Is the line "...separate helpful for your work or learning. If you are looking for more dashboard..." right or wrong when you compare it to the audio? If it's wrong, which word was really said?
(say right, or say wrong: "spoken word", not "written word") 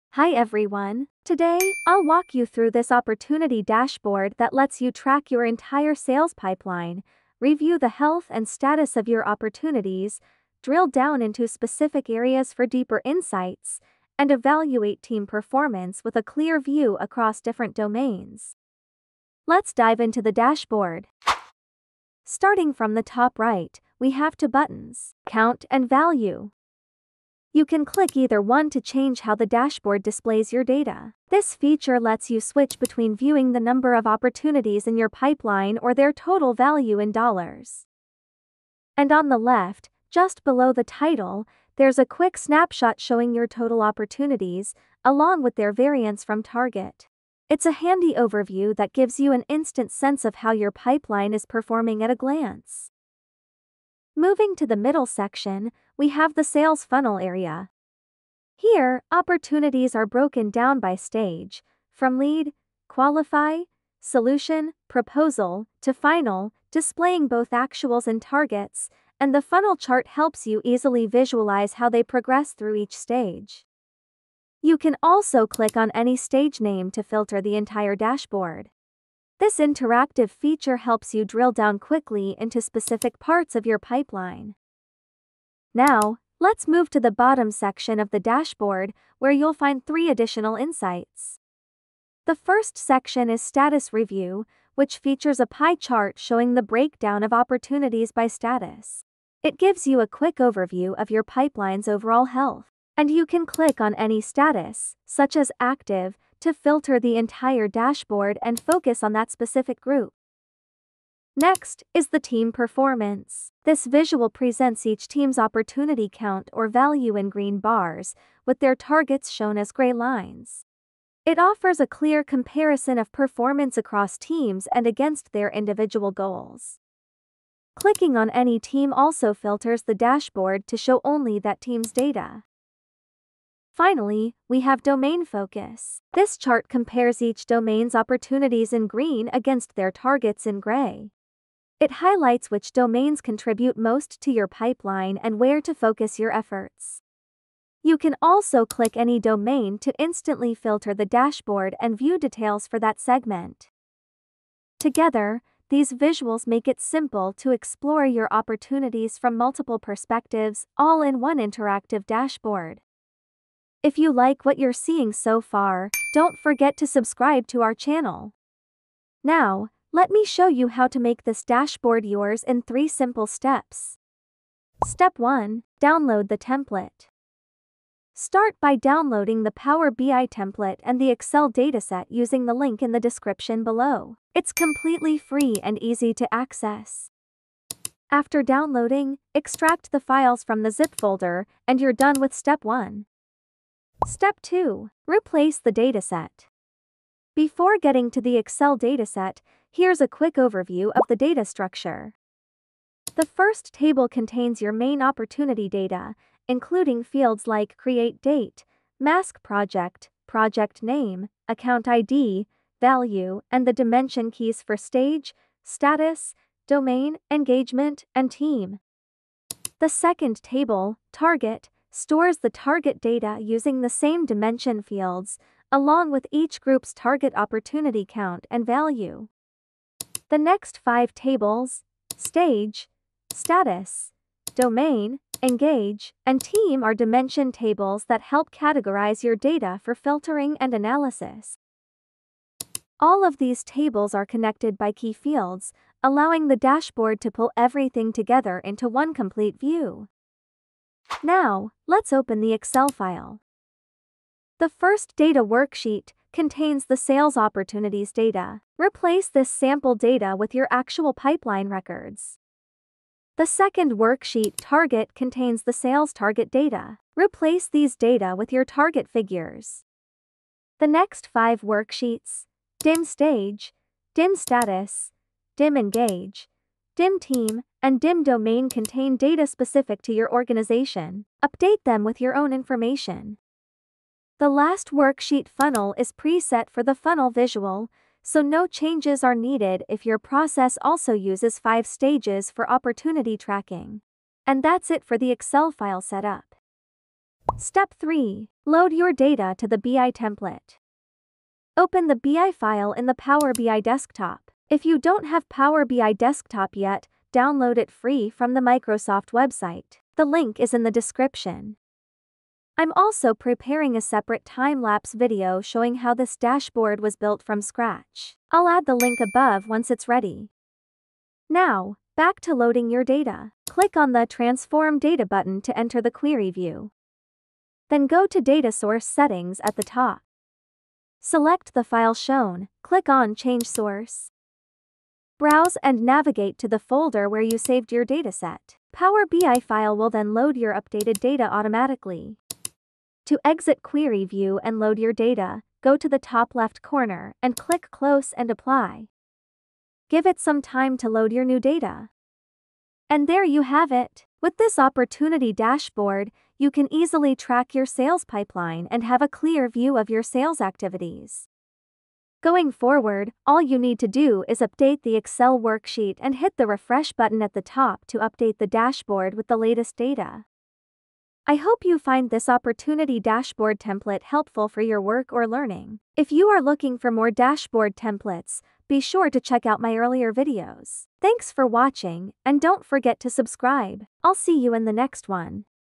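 wrong: "template", not "separate".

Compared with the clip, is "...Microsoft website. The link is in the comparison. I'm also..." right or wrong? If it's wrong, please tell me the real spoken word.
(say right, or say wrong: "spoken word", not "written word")
wrong: "description", not "comparison".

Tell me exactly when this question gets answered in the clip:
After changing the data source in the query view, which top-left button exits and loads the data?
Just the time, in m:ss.
5:47.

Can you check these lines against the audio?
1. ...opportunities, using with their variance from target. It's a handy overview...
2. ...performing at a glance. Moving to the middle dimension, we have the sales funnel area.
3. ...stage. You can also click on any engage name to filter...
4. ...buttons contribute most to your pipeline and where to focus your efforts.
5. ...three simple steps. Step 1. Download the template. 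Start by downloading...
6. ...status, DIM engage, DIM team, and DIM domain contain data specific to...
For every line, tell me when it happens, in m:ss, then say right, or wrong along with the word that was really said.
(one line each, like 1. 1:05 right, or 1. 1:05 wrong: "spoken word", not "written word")
1. 0:43 wrong: "along", not "using"
2. 0:51 wrong: "section", not "dimension"
3. 1:12 wrong: "stage", not "engage"
4. 2:22 wrong: "domains", not "buttons"
5. 2:52 right
6. 4:34 right.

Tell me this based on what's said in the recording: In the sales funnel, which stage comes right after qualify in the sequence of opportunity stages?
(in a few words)
Solution.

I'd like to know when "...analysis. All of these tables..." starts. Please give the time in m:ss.
4:00.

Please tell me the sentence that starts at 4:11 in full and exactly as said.
Now, let's open the Excel file.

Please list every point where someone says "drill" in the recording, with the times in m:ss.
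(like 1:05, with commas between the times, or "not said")
0:10, 1:21.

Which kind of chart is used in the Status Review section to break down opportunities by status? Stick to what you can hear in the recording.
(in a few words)
Pie chart.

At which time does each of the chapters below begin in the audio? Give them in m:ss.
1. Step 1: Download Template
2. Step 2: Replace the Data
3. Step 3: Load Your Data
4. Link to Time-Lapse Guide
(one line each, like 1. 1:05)
1. 2:55
2. 3:14
3. 4:58
4. 5:19.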